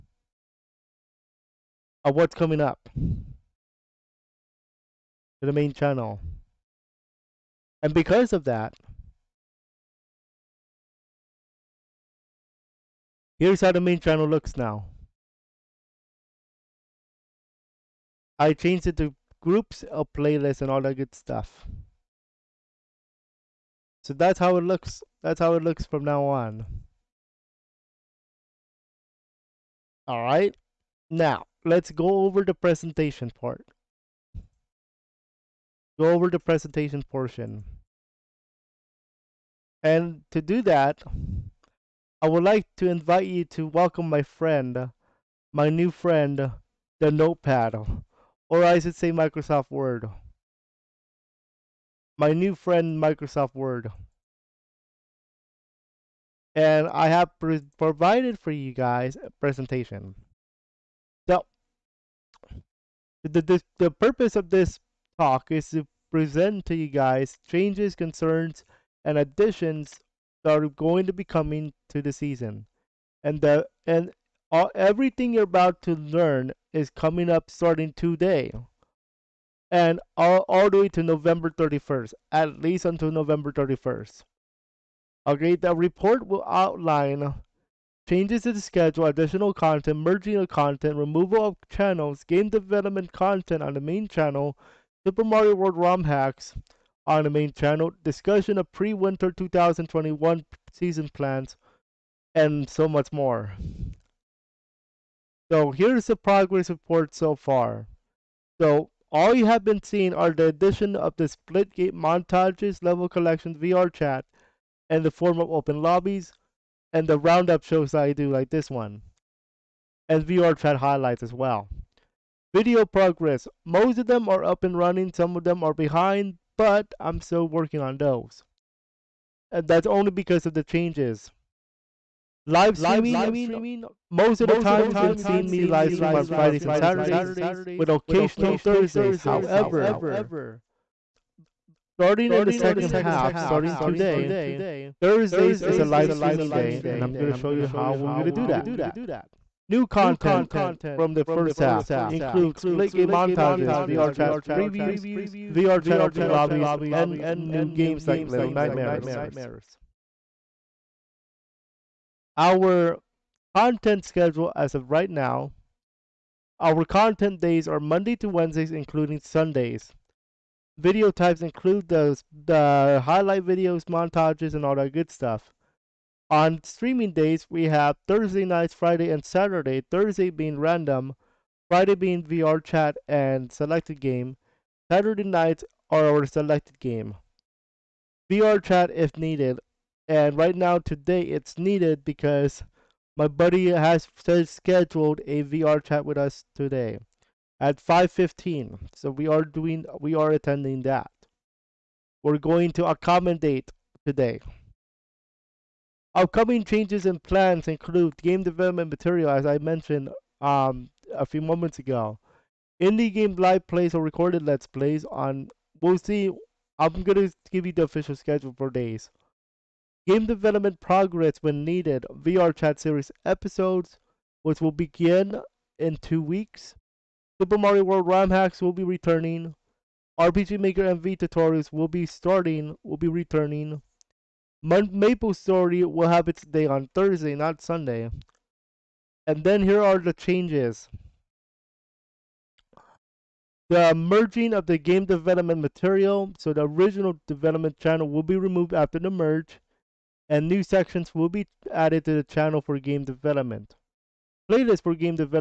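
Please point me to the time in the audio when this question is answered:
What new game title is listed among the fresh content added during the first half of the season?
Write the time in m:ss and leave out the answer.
2:38.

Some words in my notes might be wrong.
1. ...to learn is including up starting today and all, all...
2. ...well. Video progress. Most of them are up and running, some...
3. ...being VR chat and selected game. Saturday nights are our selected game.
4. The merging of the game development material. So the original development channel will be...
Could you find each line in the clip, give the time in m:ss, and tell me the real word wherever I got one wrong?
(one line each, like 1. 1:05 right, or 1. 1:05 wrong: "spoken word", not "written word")
1. 1:15 wrong: "coming", not "including"
2. 2:01 right
3. 3:01 right
4. 4:03 right.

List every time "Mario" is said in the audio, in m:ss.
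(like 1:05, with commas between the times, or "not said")
1:35, 3:47.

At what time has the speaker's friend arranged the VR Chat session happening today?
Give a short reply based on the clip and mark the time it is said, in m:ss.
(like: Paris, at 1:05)
5:15, at 3:17.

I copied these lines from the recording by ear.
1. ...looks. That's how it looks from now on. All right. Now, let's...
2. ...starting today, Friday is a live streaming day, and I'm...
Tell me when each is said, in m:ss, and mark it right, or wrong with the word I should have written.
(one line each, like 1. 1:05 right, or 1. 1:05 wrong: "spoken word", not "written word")
1. 0:24 right
2. 2:23 wrong: "Thursdays", not "Friday".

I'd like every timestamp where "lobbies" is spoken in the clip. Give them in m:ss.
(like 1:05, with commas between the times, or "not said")
1:55, 2:36.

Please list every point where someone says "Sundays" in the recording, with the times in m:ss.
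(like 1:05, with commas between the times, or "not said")
2:49, 3:57.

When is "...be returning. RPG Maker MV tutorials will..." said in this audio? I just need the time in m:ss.
3:48.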